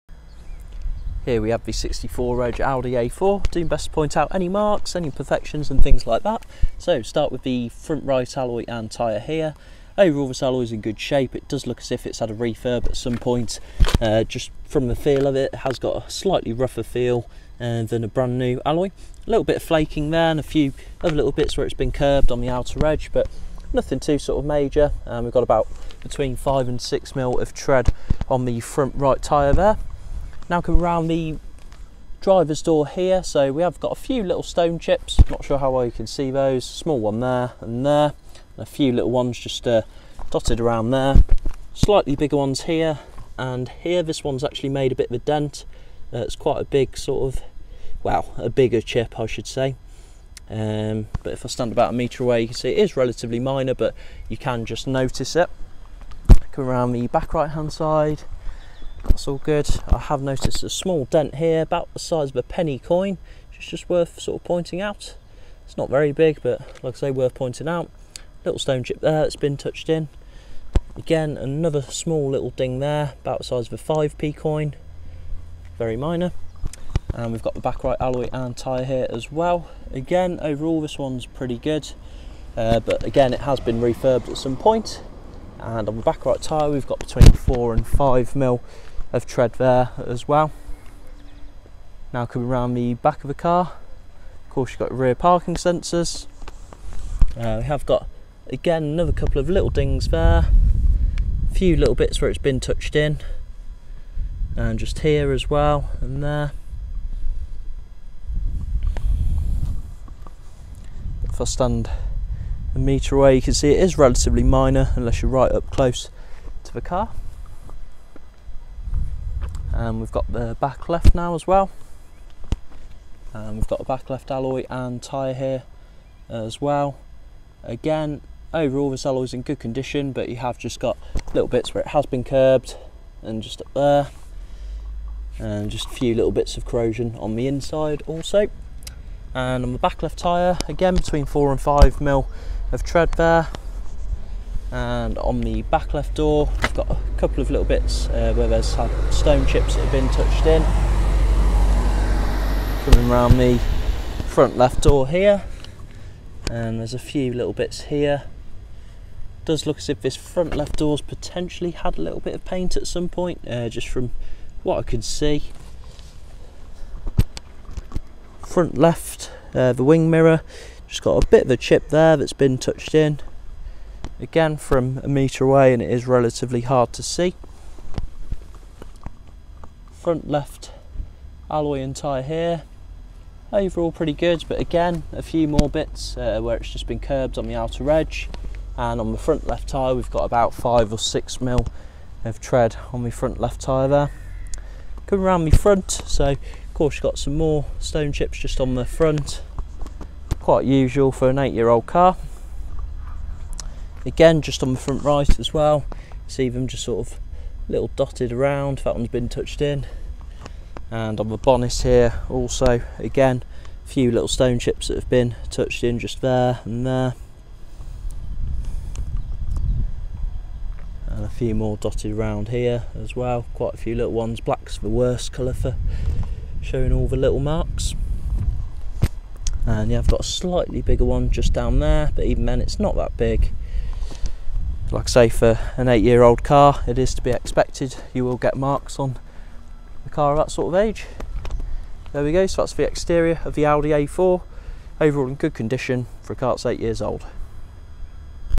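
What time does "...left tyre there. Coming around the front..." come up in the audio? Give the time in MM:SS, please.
03:13.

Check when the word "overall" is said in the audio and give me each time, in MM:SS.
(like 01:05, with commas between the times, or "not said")
00:09, 01:20, 02:08, 03:03, 04:04.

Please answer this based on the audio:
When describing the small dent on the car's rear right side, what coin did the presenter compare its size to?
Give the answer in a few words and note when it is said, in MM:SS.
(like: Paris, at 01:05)
penny coin, at 01:02.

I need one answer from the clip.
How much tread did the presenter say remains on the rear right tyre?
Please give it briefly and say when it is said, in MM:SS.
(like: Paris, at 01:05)
between 4 and 5 mm, at 01:26.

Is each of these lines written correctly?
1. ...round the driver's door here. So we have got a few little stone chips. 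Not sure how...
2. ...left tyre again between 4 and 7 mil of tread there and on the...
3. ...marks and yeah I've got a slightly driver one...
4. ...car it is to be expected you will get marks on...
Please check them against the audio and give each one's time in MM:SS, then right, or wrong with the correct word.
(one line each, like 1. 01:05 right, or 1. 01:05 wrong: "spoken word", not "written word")
1. 00:30 right
2. 02:20 wrong: "5", not "7"
3. 03:47 wrong: "bigger", not "driver"
4. 03:56 right.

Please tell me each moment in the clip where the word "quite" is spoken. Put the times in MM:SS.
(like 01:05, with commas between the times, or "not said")
00:46, 03:20, 03:43.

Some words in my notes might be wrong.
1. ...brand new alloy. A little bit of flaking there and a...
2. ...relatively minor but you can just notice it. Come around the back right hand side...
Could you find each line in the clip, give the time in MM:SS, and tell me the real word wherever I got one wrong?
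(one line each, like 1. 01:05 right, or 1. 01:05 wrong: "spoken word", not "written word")
1. 00:18 right
2. 00:52 right.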